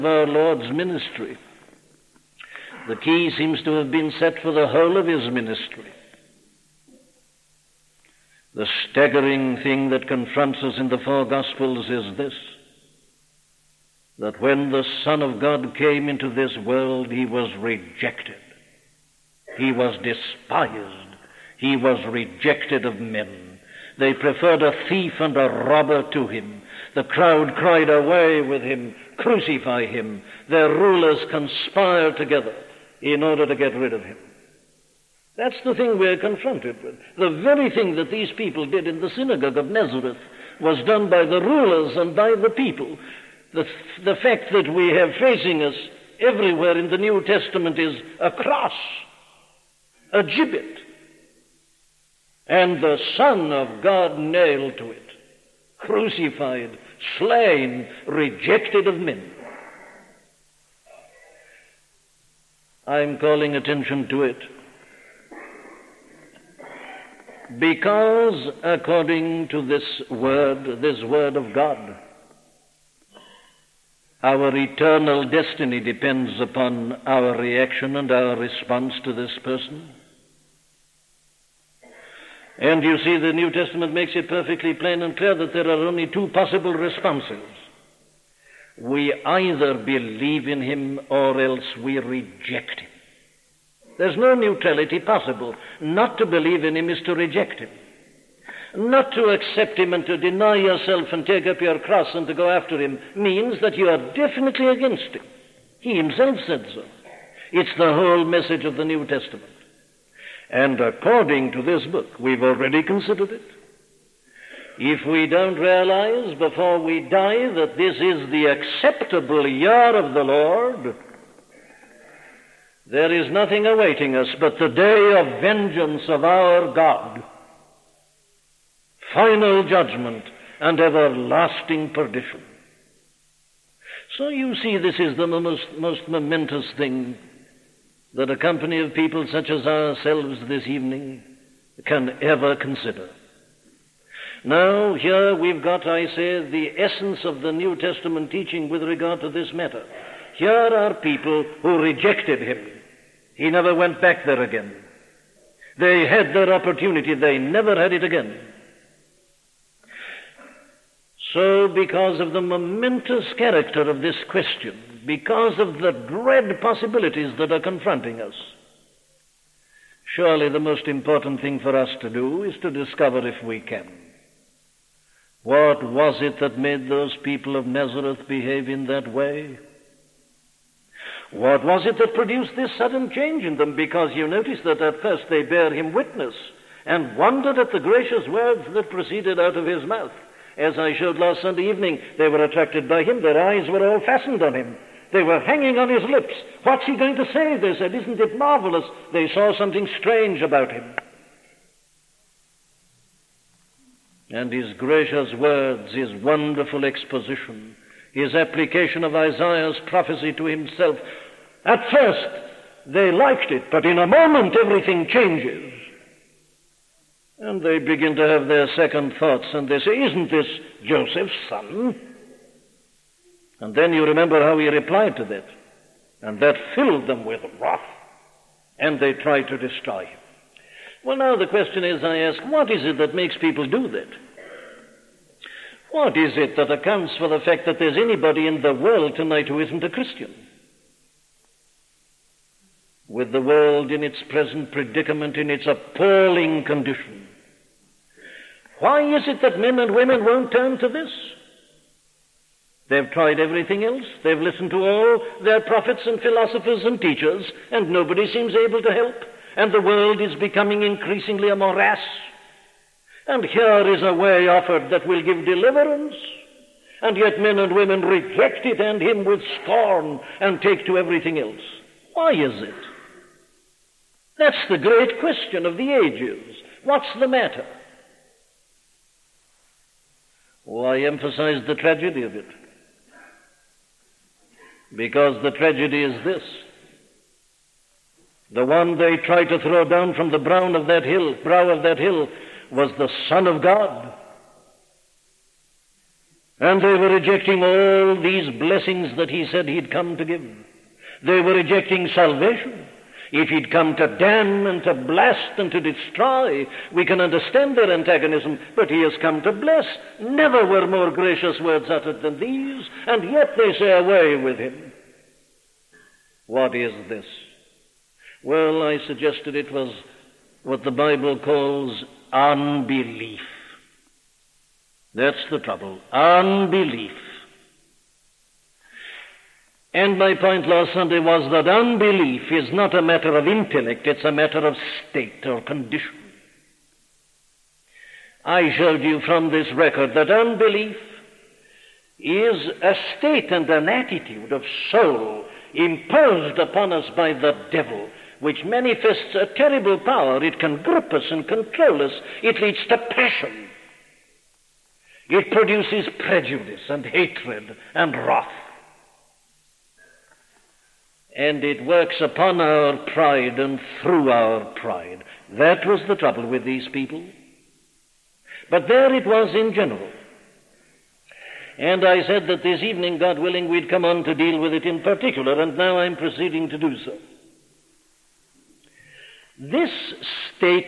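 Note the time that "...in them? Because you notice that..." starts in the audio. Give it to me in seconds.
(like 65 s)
183 s.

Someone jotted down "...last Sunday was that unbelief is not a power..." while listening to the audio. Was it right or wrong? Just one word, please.
wrong.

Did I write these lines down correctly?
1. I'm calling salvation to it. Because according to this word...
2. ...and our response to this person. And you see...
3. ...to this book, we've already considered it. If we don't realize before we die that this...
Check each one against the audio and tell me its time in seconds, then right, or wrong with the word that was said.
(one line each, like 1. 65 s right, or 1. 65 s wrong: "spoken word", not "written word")
1. 62 s wrong: "attention", not "salvation"
2. 77 s right
3. 111 s right.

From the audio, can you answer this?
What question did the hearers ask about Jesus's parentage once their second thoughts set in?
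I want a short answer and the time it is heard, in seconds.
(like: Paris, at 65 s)
Isn't this Joseph's son?, at 220 s.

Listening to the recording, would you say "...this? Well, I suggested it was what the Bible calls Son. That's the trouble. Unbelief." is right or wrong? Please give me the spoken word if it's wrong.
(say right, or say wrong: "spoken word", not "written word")
wrong: "Unbelief", not "Son".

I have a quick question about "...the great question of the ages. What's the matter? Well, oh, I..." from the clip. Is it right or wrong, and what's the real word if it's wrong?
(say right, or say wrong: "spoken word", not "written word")
right.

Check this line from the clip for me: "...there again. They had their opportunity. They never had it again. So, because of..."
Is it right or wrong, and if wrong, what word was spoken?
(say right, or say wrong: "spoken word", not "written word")
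right.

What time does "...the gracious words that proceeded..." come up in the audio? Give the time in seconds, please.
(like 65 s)
187 s.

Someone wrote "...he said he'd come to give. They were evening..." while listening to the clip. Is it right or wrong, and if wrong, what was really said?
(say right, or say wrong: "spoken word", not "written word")
wrong: "rejecting", not "evening".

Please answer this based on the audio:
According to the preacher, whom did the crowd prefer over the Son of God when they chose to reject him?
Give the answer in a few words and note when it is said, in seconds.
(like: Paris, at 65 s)
A thief and a robber, at 24 s.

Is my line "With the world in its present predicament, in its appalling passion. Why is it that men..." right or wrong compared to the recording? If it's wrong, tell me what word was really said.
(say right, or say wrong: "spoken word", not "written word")
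wrong: "condition", not "passion".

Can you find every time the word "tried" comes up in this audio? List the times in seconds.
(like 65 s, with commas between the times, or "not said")
229 s, 253 s.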